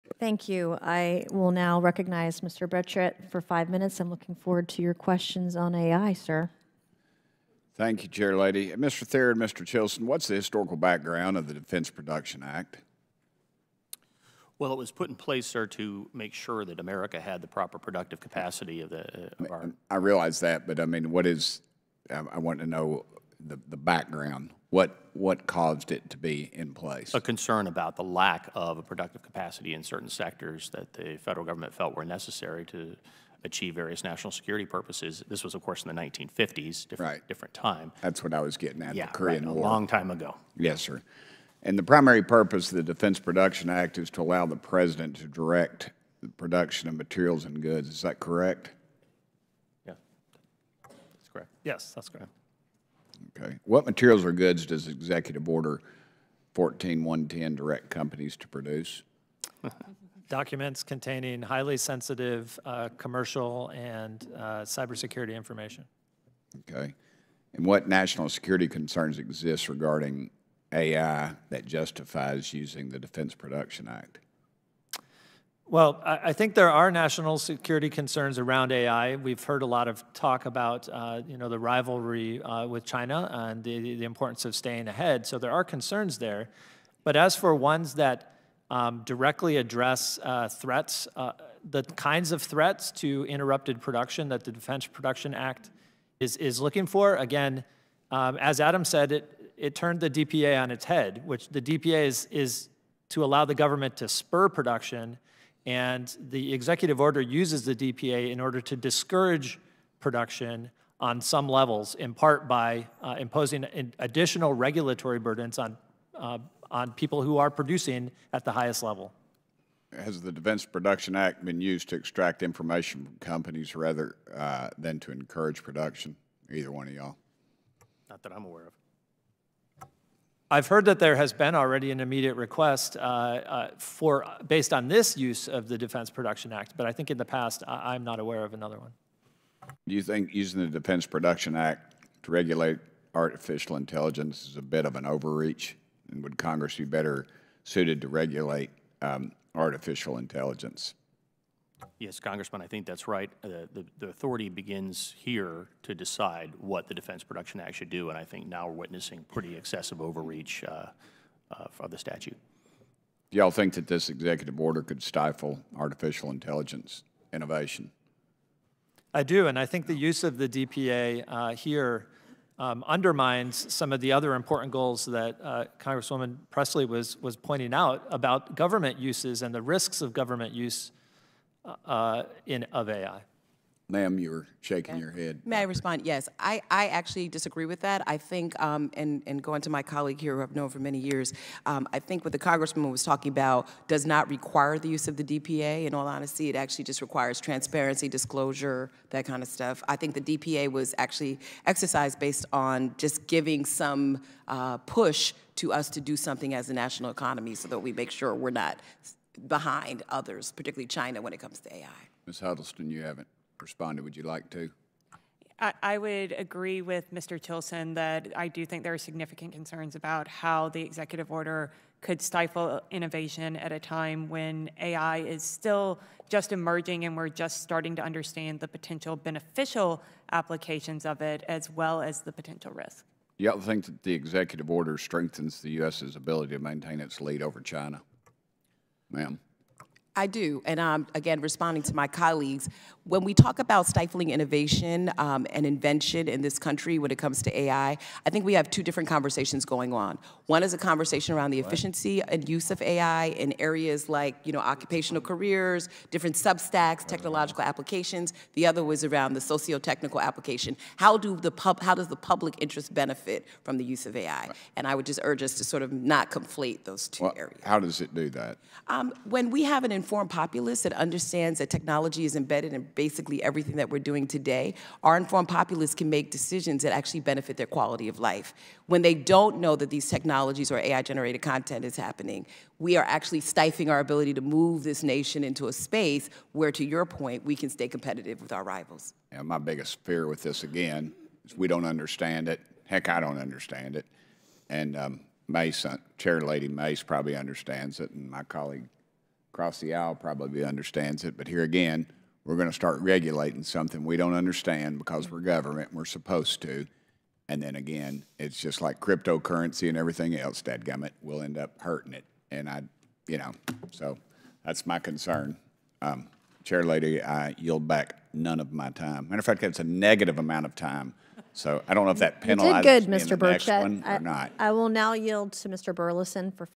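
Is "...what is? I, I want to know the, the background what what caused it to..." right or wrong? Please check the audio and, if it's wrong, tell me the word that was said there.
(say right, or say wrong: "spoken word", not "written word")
right.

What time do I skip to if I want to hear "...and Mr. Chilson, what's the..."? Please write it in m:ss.
0:09.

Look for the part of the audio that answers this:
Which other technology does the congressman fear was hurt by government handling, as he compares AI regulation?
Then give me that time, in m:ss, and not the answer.
5:09.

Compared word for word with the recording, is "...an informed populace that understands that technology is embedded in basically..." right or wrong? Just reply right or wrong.
right.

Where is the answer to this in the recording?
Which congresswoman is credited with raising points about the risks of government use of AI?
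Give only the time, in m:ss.
2:56.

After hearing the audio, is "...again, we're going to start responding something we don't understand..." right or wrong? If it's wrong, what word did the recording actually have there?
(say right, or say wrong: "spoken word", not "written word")
wrong: "regulating", not "responding".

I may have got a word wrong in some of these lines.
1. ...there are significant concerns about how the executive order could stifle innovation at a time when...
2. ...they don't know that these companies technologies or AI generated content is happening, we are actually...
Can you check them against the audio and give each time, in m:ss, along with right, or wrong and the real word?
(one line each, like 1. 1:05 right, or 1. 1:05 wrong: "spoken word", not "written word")
1. 3:38 right
2. 4:39 wrong: "technologies", not "companies".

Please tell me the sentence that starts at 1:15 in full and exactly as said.
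Well, I think there are national security concerns around AI.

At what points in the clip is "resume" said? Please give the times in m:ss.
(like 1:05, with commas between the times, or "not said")
not said.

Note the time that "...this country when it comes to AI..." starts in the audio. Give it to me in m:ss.
4:06.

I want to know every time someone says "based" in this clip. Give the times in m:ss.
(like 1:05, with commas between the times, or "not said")
2:14, 3:22.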